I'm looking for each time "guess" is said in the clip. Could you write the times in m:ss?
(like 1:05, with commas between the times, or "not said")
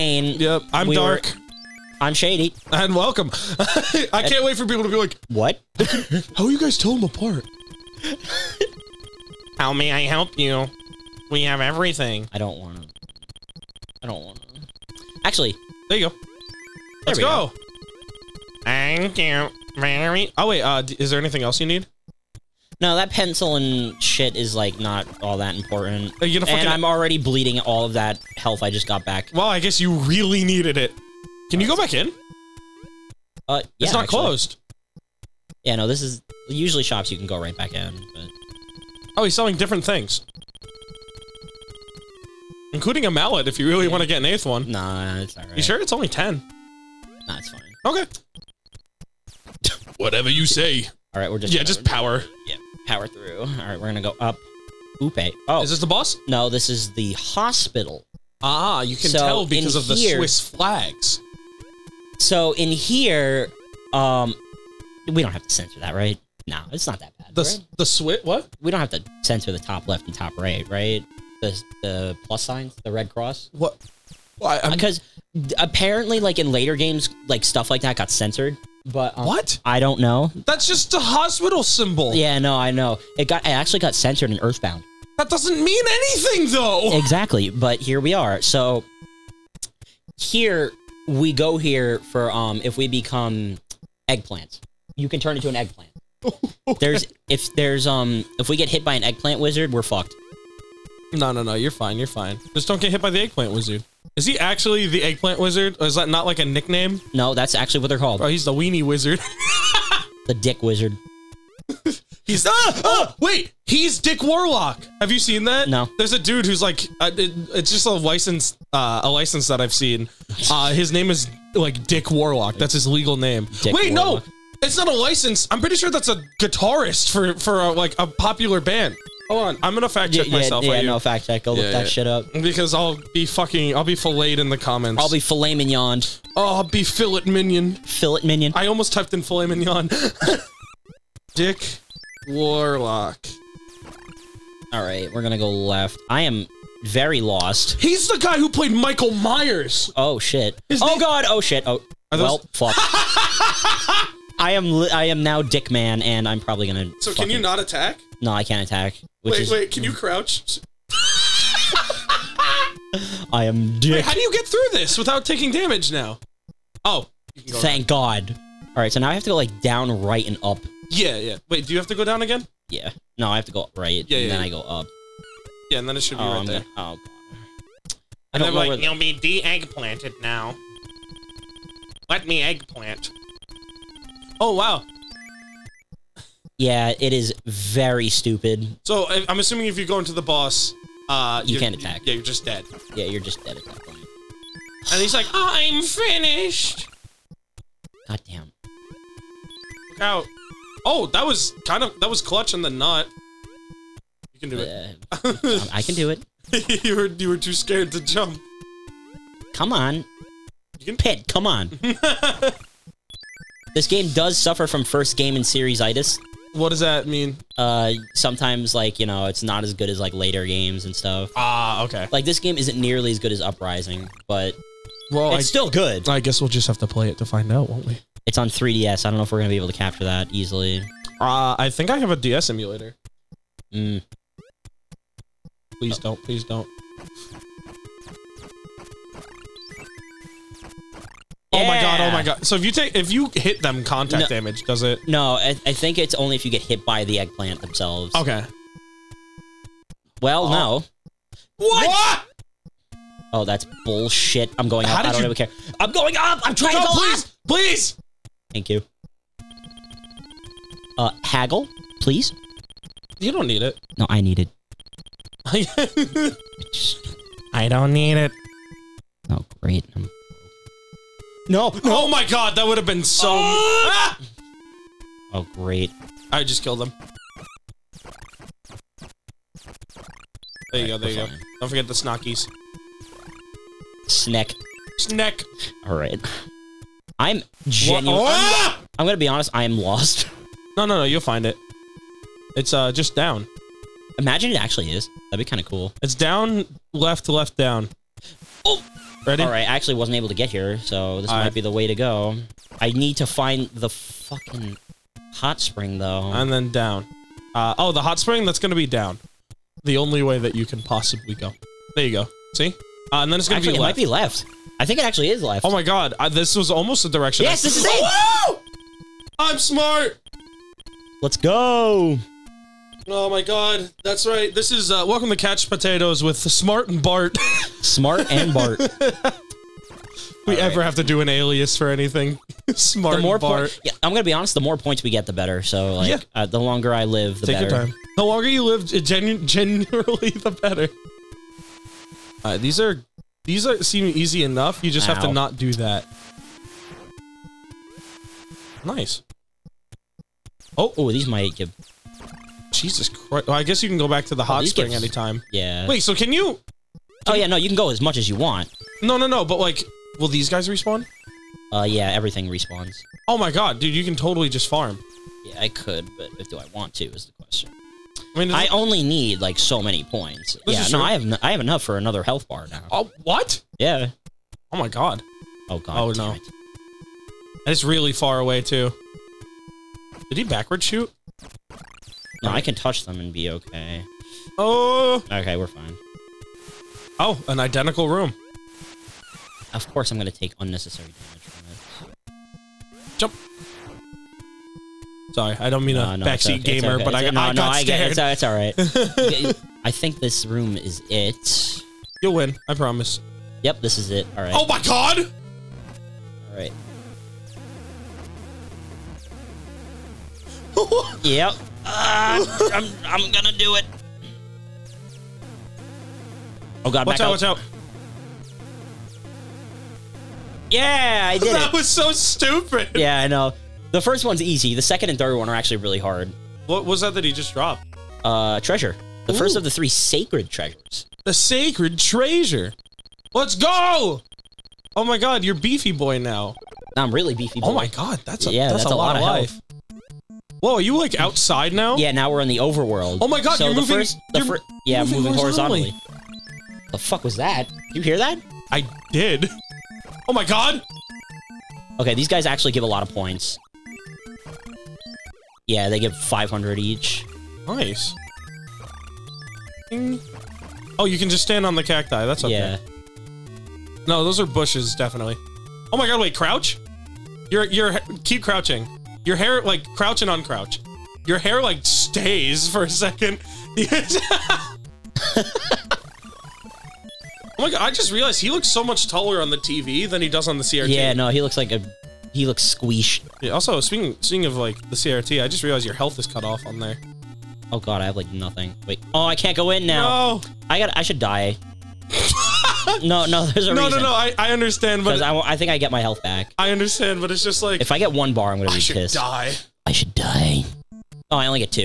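0:29, 3:46, 5:53.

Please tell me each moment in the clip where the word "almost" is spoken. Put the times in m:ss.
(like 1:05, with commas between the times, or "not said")
2:18, 5:16.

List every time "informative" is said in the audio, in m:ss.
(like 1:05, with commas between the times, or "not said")
not said.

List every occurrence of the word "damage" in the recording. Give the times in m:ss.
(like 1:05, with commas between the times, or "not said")
2:45, 4:04, 6:31.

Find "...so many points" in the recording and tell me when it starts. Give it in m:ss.
6:09.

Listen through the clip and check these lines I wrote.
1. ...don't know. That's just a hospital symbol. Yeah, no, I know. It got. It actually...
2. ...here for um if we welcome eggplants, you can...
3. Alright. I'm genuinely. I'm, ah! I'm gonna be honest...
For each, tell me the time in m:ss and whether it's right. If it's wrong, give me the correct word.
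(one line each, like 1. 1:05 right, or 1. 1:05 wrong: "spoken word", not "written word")
1. 1:19 right
2. 1:31 wrong: "become", not "welcome"
3. 4:45 right.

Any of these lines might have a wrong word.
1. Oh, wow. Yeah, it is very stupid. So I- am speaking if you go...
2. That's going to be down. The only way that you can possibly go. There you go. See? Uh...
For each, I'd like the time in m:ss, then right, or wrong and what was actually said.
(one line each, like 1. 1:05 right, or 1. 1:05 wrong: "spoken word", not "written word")
1. 3:04 wrong: "assuming", not "speaking"
2. 5:08 right.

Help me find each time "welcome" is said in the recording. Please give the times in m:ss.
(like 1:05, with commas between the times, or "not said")
0:02, 5:25.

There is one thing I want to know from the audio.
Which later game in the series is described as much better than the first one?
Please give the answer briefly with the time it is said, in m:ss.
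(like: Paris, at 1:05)
Uprising, at 3:43.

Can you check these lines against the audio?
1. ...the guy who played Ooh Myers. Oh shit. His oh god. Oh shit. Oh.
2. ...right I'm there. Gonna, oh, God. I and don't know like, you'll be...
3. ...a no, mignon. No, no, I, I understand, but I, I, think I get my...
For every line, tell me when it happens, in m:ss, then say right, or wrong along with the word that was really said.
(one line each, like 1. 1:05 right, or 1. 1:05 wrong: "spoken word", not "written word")
1. 2:28 wrong: "Michael", not "Ooh"
2. 2:56 right
3. 8:13 wrong: "reason", not "mignon".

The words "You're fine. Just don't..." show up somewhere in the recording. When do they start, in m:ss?
1:41.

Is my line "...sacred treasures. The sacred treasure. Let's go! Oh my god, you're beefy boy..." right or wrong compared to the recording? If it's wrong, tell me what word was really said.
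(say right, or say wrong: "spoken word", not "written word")
right.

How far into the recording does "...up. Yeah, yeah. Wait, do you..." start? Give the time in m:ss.
2:50.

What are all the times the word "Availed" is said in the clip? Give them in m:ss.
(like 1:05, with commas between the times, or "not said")
not said.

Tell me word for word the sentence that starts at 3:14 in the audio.
And he's like, "I'm finished." God damn.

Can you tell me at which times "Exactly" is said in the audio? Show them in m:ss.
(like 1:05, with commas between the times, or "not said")
1:26.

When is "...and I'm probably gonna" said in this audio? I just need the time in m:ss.
2:36.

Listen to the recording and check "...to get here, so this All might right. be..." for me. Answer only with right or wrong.
right.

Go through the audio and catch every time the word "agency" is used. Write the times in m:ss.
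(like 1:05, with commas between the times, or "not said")
not said.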